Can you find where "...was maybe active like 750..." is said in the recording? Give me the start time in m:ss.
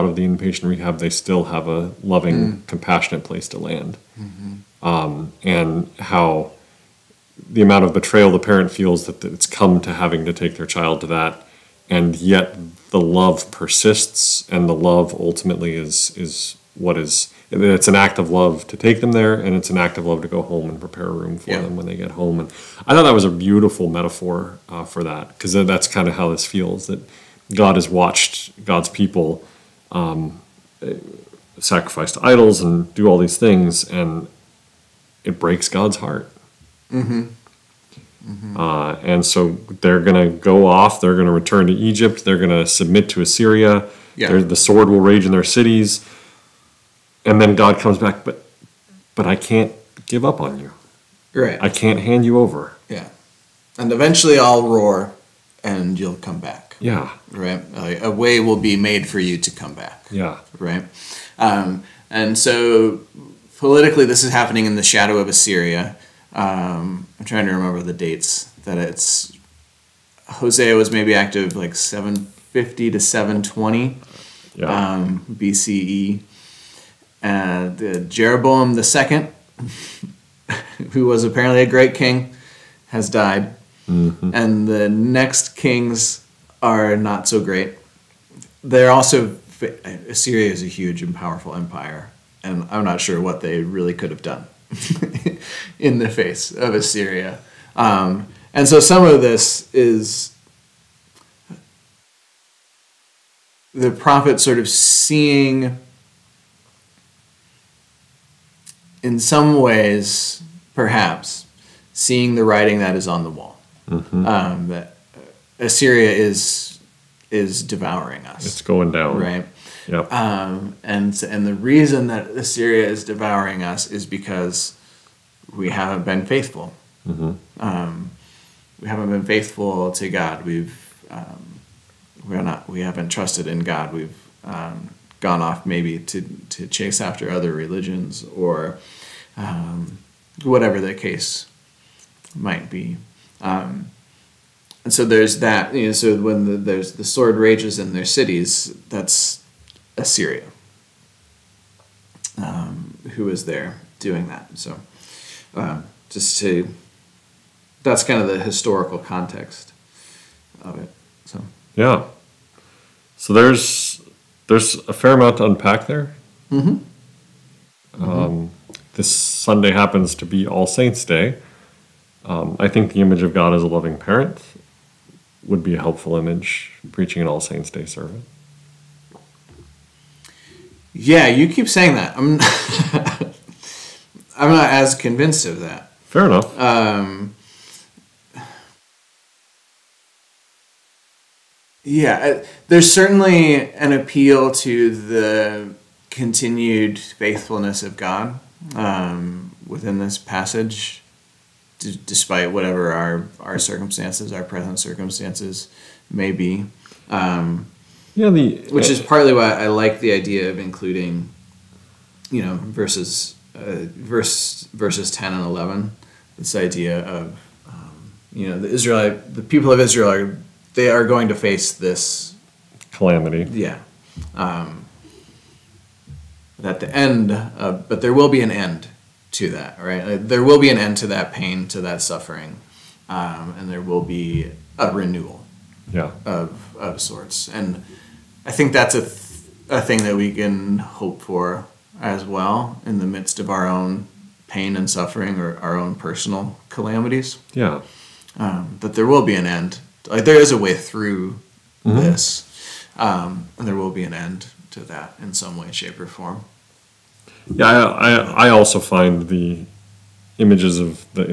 1:10.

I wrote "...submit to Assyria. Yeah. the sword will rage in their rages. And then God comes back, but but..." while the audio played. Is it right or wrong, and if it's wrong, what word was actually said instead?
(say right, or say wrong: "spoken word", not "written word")
wrong: "cities", not "rages".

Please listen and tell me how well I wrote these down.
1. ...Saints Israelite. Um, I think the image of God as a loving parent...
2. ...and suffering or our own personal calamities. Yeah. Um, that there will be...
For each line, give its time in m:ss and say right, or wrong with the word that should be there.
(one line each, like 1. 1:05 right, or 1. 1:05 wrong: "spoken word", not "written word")
1. 2:50 wrong: "Day", not "Israelite"
2. 4:04 right.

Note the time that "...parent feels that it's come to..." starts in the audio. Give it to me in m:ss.
0:08.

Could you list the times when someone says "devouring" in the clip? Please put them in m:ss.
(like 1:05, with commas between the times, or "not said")
1:57, 2:03.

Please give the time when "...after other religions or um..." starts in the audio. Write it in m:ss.
2:17.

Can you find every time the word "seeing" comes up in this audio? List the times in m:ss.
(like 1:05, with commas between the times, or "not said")
1:44, 1:51.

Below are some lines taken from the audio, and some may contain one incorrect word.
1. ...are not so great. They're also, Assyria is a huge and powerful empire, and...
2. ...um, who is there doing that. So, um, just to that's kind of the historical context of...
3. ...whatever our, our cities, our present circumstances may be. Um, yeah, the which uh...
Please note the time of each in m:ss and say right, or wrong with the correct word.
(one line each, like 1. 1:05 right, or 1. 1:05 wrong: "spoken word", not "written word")
1. 1:26 right
2. 2:32 right
3. 3:22 wrong: "circumstances", not "cities".